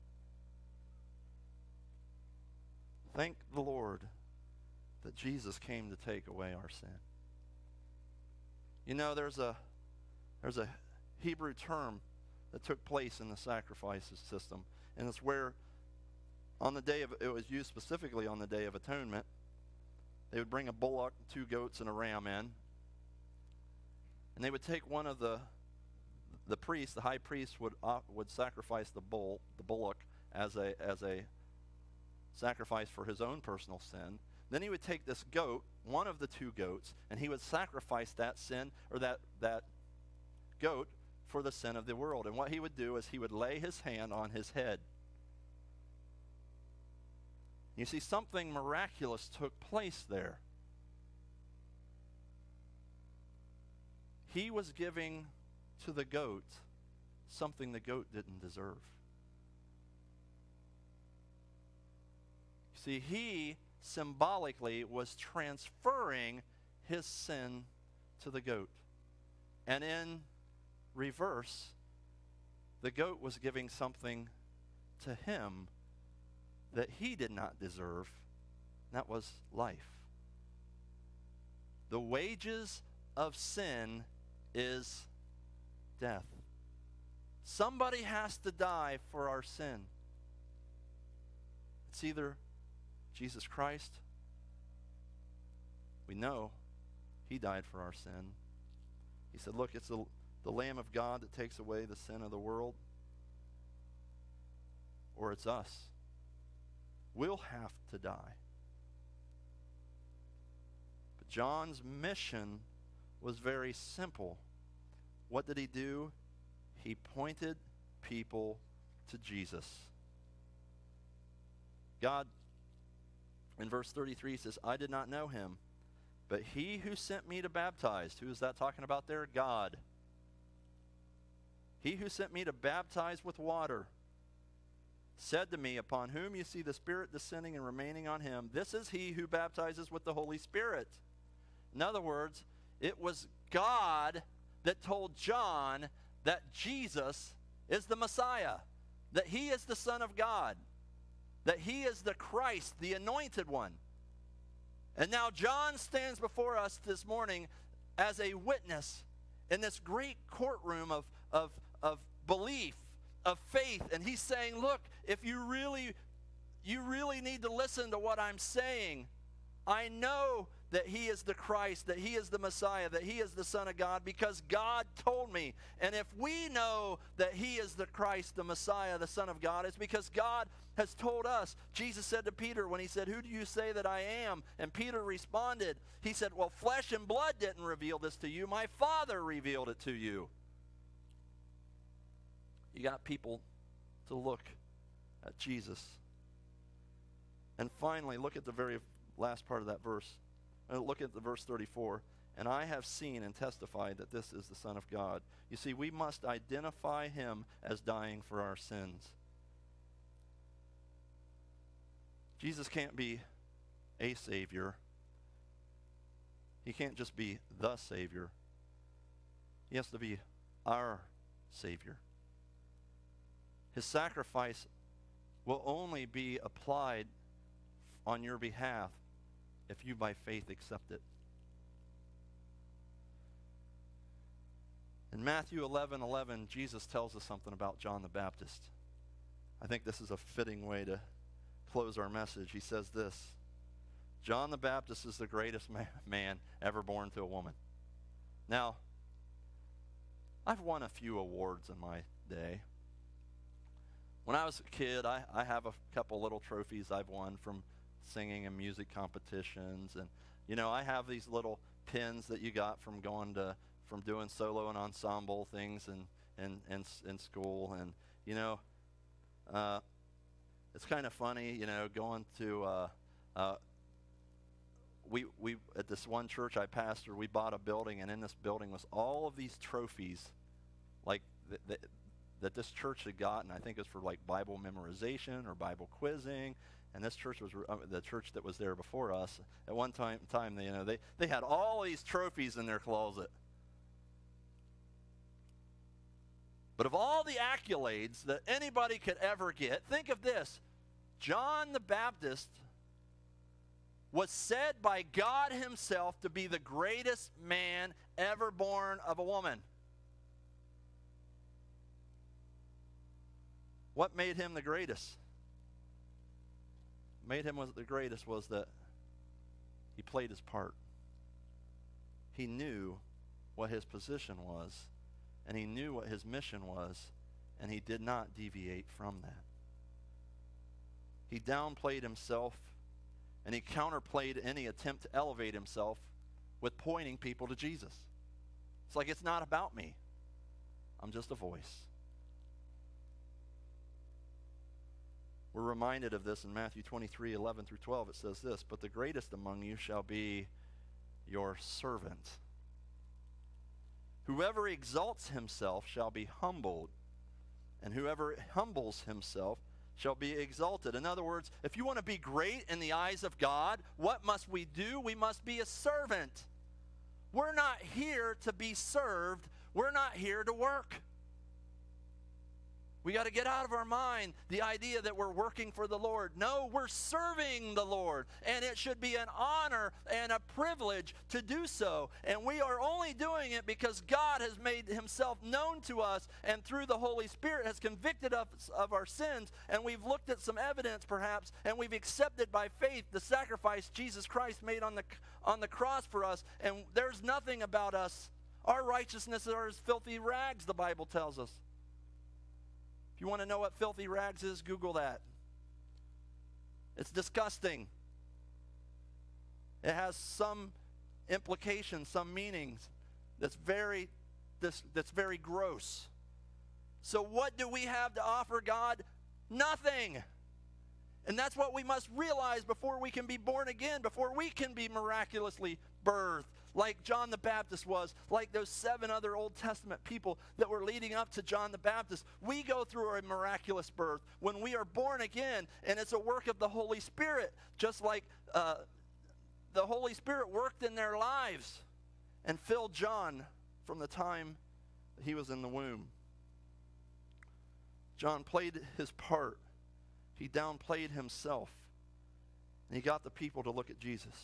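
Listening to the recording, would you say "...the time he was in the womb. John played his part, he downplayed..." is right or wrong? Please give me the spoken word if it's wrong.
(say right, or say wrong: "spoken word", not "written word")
right.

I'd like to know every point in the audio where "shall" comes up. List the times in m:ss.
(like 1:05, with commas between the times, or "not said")
5:49, 5:55, 5:59.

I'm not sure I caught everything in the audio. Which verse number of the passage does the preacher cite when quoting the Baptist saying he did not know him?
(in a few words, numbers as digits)
33.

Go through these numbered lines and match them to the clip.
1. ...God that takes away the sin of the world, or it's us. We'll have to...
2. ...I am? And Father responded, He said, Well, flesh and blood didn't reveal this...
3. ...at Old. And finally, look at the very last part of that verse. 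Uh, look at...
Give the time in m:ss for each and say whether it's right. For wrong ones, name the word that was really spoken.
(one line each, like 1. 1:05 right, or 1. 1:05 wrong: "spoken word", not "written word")
1. 1:40 right
2. 3:03 wrong: "Peter", not "Father"
3. 3:15 wrong: "Jesus", not "Old".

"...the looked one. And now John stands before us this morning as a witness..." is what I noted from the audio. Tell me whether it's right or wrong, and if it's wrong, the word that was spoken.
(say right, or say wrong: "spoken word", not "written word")
wrong: "anointed", not "looked".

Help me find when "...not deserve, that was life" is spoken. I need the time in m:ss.
1:17.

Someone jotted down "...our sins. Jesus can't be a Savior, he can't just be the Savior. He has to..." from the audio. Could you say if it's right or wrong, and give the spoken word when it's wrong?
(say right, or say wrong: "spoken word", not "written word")
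right.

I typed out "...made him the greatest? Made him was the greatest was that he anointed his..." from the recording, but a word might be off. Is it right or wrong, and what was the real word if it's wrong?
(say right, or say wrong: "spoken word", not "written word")
wrong: "played", not "anointed".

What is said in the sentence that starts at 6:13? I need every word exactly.
We got to get out of our mind the idea that we're working for the Lord.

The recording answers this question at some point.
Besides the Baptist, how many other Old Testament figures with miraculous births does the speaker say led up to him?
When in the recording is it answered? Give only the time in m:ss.
7:08.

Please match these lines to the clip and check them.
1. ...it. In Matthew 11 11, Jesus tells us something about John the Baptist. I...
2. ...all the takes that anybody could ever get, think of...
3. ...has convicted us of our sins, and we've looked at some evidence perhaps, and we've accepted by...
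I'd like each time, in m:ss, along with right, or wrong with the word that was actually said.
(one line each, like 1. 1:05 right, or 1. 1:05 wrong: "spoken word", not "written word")
1. 3:50 right
2. 4:56 wrong: "accolades", not "takes"
3. 6:27 right.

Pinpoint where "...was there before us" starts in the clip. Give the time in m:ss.
4:48.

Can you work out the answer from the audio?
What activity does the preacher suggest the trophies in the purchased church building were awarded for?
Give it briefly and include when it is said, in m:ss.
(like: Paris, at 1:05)
Bible memorization, at 4:44.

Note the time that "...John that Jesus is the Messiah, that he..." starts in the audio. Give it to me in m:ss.
2:25.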